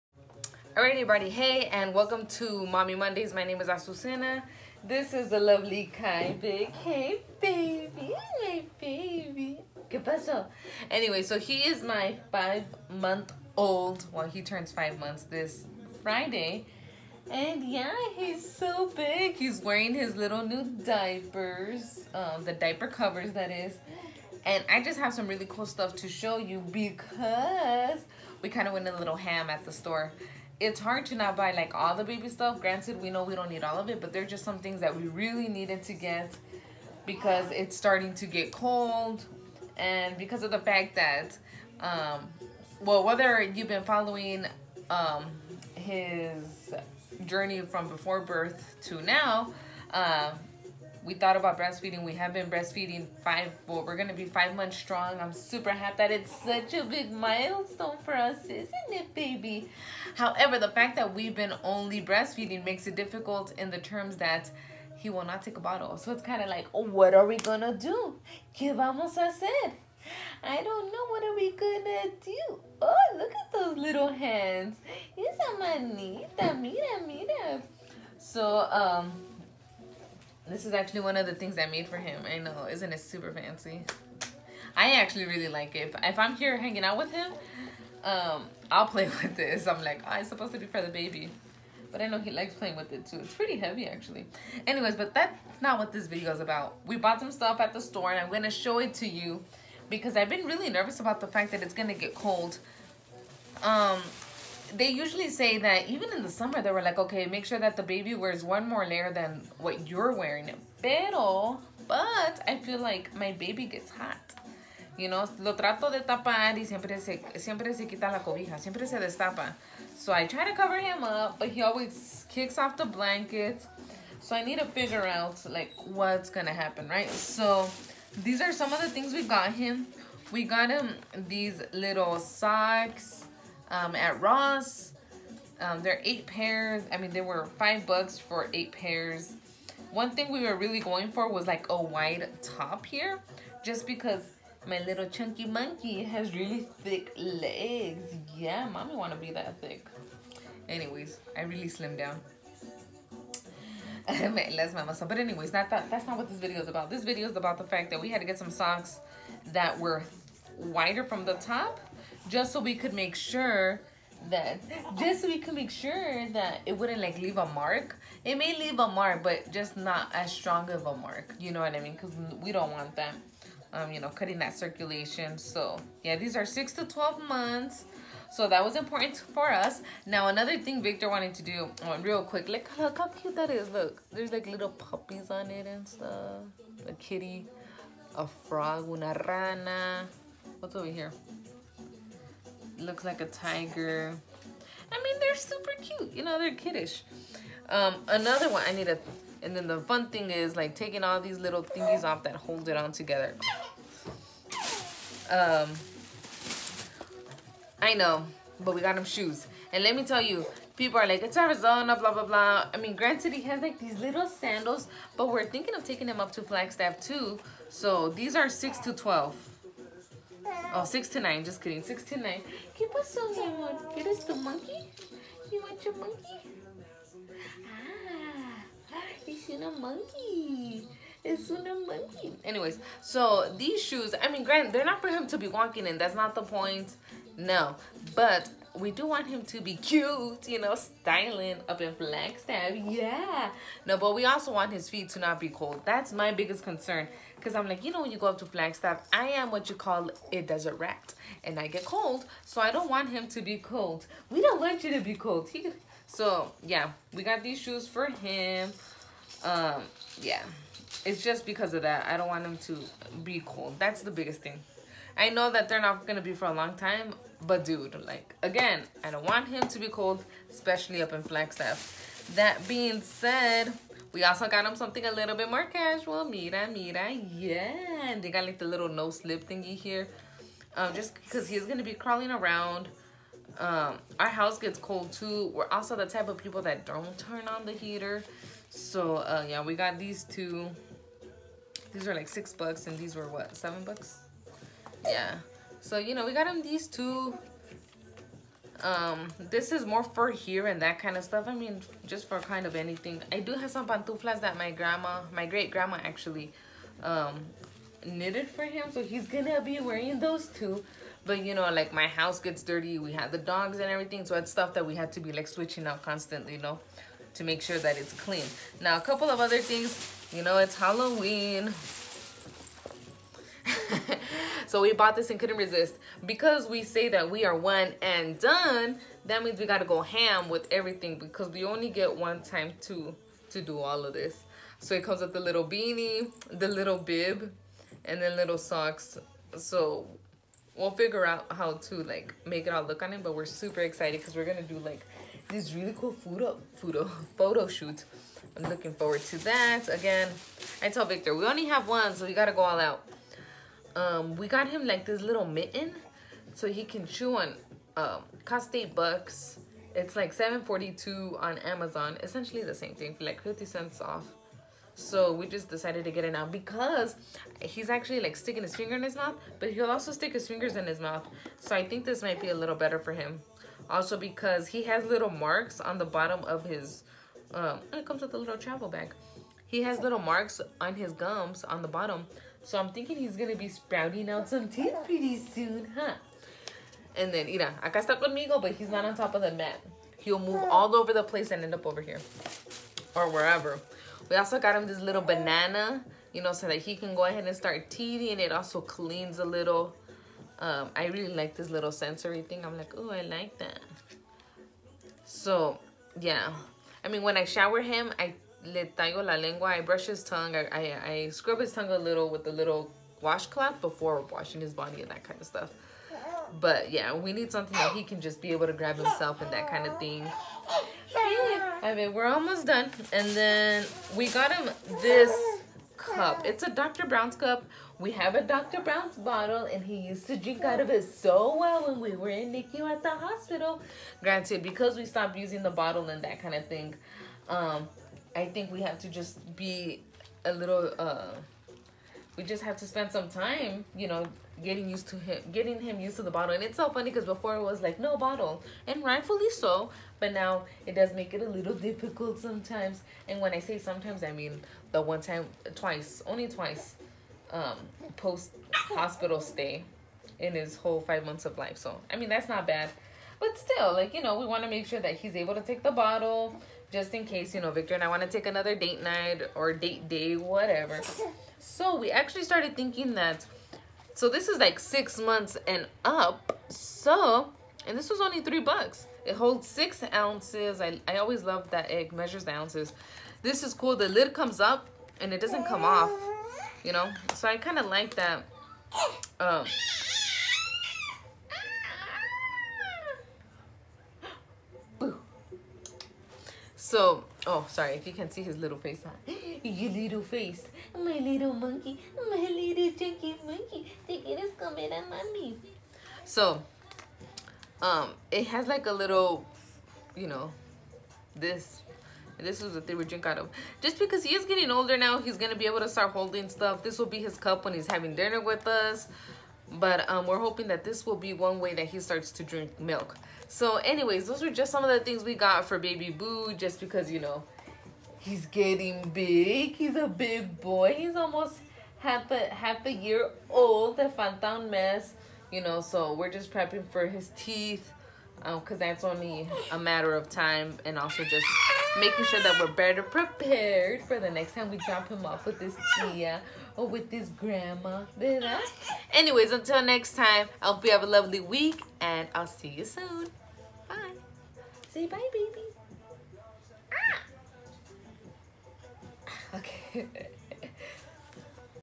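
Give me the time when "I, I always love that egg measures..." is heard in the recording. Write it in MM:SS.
08:00.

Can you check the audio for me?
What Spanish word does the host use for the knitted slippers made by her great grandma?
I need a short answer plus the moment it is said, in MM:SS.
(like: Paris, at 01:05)
pantuflas, at 05:03.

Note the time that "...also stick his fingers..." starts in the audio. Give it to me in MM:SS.
06:09.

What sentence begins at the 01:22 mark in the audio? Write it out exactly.
I know, isn't it super fancy?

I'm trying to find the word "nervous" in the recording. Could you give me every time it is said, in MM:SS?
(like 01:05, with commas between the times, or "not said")
01:40.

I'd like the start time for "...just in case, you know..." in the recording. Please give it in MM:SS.
07:46.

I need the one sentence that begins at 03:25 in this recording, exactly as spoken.
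Um, I know, but we got them shoes.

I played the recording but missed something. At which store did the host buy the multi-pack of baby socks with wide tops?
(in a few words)
Ross.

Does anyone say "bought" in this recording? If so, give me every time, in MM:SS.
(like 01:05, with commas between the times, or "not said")
01:36, 05:24.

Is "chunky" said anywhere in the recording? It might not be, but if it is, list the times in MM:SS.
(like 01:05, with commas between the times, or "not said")
02:25, 08:22.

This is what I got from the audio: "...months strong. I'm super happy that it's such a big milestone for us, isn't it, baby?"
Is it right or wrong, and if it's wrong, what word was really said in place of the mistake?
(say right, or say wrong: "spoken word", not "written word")
right.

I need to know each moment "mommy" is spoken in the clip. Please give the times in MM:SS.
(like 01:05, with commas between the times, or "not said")
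00:02, 02:28, 08:25.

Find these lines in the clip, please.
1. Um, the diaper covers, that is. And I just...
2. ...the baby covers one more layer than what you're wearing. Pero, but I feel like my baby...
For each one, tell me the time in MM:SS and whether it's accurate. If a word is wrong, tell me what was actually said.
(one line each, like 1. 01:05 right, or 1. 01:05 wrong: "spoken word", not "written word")
1. 00:22 right
2. 01:47 wrong: "wears", not "covers".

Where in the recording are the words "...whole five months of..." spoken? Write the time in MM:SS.
07:40.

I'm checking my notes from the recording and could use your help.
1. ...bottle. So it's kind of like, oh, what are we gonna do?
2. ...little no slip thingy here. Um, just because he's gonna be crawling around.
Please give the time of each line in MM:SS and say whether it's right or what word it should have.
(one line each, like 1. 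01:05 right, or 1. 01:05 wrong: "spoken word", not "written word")
1. 01:05 right
2. 04:38 right.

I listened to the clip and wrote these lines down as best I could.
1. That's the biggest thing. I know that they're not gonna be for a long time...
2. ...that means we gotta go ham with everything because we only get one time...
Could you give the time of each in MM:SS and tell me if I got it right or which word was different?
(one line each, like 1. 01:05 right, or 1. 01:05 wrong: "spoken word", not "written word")
1. 04:23 right
2. 05:29 right.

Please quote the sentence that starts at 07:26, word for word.
And it's so funny because before it was like no bottle, and rightfully so.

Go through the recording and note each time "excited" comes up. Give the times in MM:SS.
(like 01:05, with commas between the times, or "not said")
05:43.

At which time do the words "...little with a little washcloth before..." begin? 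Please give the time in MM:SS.
06:51.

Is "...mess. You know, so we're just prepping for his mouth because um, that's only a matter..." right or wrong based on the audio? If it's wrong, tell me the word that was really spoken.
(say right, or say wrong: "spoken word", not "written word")
wrong: "teeth", not "mouth".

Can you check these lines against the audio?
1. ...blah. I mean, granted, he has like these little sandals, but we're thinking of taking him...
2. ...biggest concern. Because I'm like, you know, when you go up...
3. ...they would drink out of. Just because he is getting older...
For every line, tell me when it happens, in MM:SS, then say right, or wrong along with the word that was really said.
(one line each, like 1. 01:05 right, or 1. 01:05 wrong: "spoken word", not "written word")
1. 03:32 right
2. 04:06 right
3. 08:32 right.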